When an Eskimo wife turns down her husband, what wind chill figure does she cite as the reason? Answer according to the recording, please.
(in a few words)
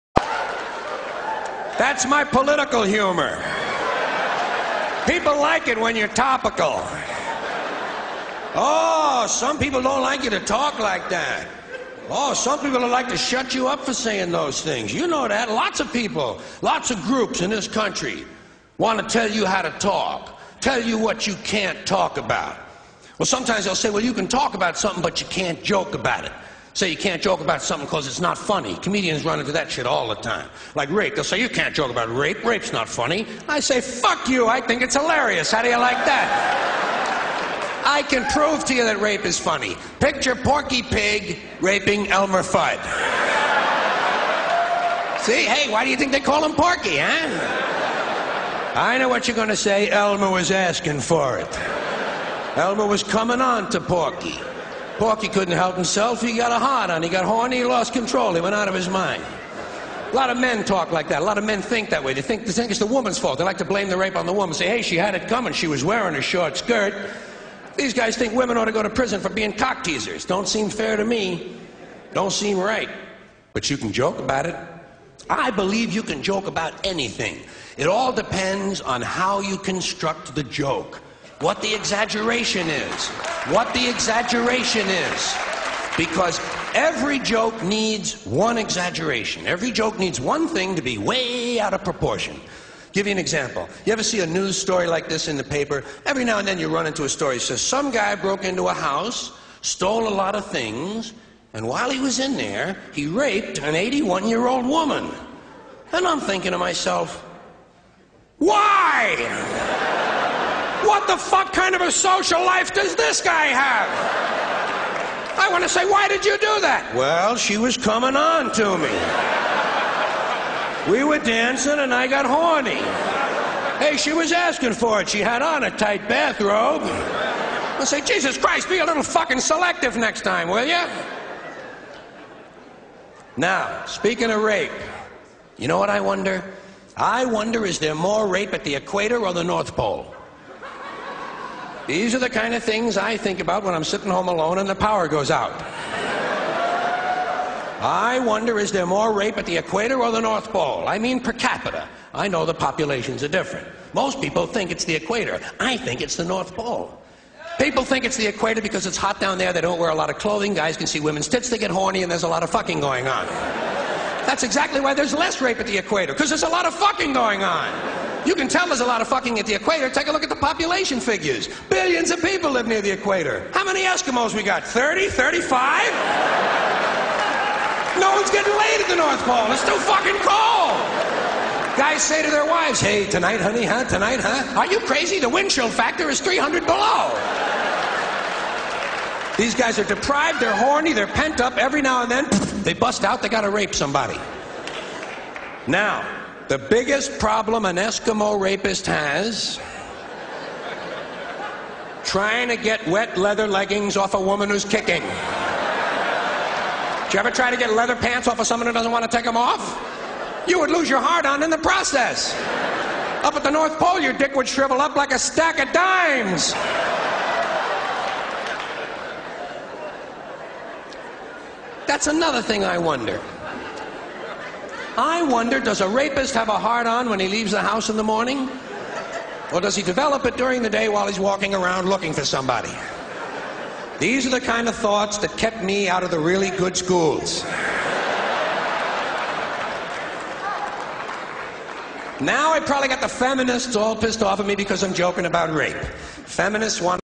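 300 below.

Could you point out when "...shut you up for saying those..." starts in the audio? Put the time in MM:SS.
00:13.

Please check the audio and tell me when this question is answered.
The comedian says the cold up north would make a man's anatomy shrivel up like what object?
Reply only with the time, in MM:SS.
03:35.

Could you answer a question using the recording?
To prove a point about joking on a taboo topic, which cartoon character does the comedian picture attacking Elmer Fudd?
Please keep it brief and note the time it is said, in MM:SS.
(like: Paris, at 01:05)
Porky Pig, at 00:40.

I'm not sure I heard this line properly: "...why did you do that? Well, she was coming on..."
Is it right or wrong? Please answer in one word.
right.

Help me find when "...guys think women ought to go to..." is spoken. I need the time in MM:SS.
01:07.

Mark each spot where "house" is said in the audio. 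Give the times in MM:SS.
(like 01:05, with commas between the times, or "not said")
01:38, 03:47.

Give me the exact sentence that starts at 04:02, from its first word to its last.
Now I probably got the feminists all pissed off at me because I'm joking about rape.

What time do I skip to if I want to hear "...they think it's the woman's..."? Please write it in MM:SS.
01:02.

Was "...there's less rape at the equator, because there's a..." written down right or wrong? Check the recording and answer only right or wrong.
right.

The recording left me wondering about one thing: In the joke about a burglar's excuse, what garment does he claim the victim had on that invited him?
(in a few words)
Tight bathrobe.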